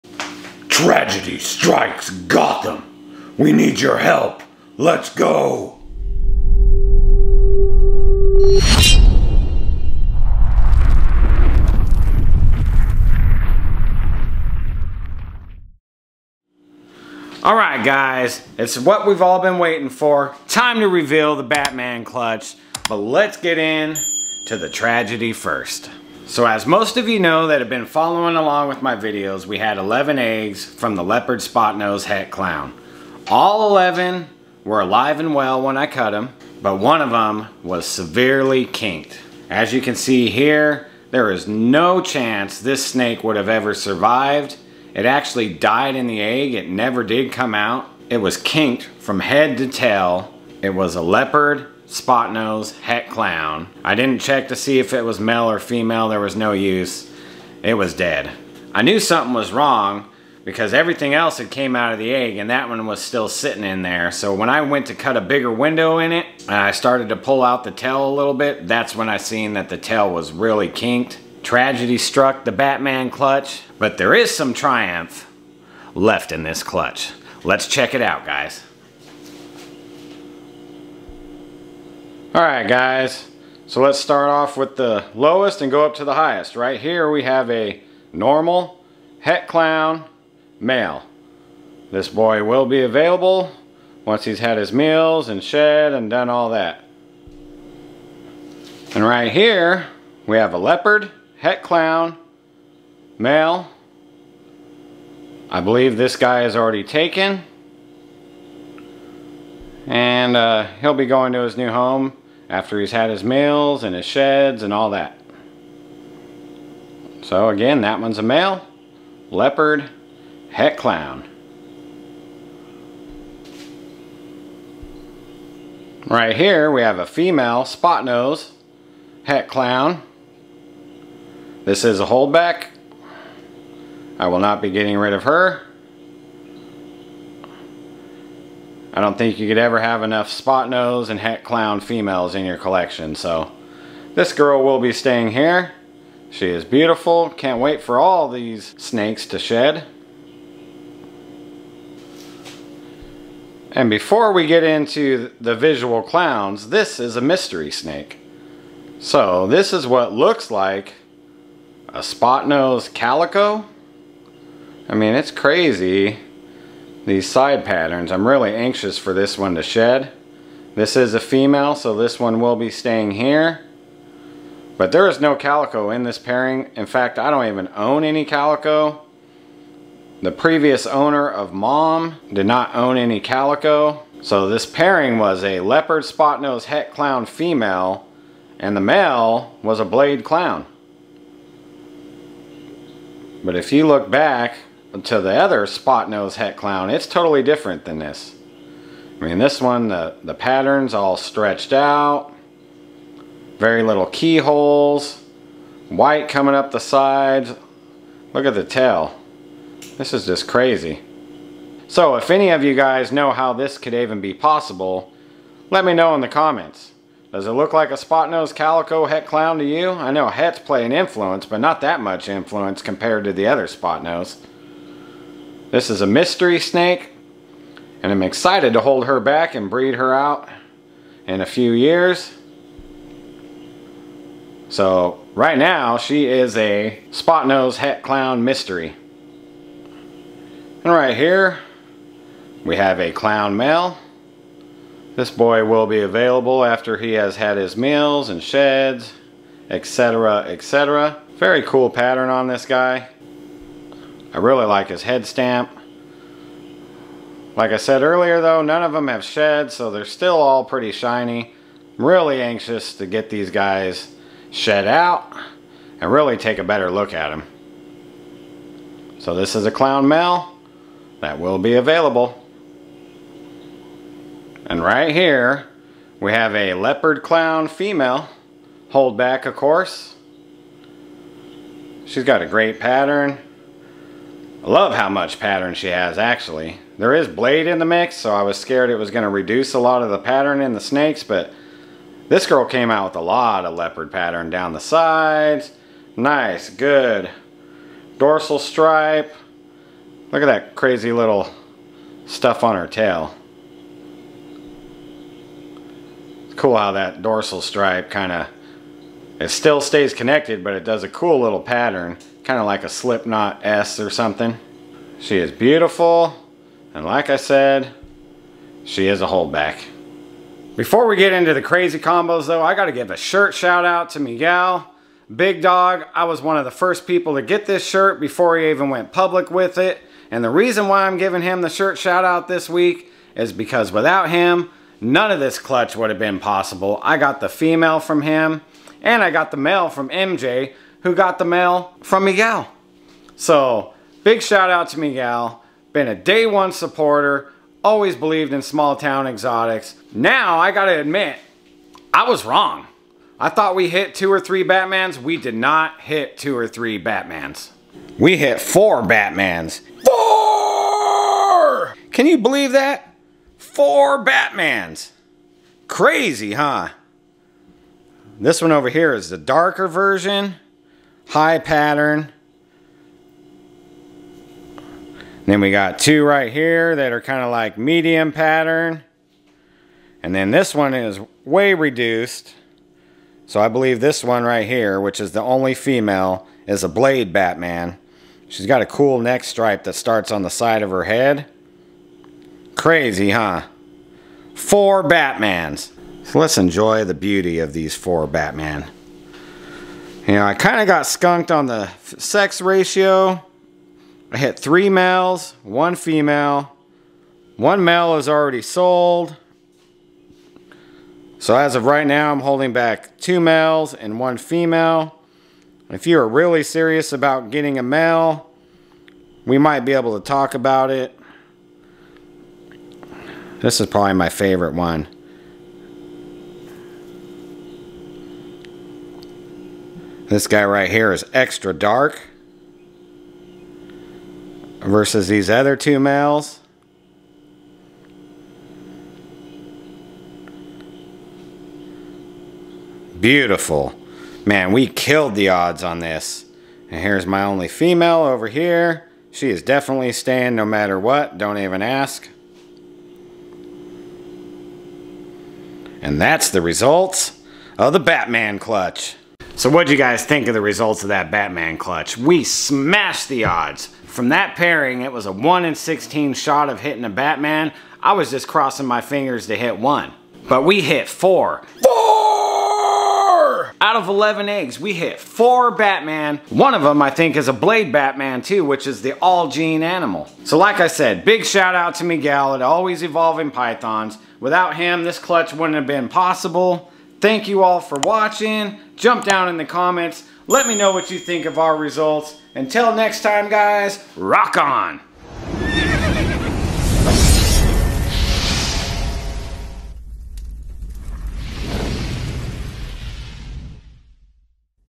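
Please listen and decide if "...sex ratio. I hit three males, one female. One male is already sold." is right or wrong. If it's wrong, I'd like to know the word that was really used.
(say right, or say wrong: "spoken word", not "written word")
right.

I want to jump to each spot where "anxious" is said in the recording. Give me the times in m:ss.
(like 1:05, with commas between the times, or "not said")
2:48, 4:22.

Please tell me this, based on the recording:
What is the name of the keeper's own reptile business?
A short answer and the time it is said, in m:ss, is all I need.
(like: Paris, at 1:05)
Small Town Xotics, at 5:48.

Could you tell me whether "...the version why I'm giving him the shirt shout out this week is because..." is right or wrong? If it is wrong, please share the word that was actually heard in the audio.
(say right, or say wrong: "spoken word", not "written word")
wrong: "reason", not "version".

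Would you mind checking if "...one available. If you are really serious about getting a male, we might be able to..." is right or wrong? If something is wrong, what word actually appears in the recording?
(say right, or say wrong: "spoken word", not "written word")
wrong: "female", not "available".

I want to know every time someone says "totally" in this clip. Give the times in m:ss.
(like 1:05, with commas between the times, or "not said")
3:17.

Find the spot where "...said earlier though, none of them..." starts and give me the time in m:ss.
4:17.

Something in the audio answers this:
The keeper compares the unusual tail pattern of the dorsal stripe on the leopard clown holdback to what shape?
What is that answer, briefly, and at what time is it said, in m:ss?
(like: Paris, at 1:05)
Slipknot S, at 5:12.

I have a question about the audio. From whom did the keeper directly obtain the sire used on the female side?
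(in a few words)
MJ.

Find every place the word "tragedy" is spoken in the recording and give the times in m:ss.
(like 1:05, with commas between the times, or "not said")
0:00, 0:24, 1:11.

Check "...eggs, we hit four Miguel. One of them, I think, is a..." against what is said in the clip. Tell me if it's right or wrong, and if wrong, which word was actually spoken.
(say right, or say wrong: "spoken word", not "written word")
wrong: "Batman", not "Miguel".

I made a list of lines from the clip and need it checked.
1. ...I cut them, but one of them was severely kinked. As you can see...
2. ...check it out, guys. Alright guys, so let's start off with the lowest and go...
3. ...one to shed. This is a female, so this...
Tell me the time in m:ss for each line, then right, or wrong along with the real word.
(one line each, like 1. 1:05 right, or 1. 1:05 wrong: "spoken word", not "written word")
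1. 0:35 right
2. 1:17 right
3. 2:49 right.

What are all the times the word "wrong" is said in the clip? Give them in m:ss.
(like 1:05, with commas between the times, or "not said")
0:59, 5:52.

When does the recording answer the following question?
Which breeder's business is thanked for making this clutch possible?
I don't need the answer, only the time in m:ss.
8:02.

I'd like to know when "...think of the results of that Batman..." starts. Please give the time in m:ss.
7:40.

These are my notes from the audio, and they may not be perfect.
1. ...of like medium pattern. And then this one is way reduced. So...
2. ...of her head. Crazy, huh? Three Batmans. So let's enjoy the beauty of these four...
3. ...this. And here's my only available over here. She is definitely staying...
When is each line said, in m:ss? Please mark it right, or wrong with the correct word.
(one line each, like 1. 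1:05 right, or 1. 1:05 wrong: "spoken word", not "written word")
1. 6:17 right
2. 6:30 wrong: "Four", not "Three"
3. 7:25 wrong: "female", not "available".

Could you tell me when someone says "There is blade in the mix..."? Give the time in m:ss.
4:46.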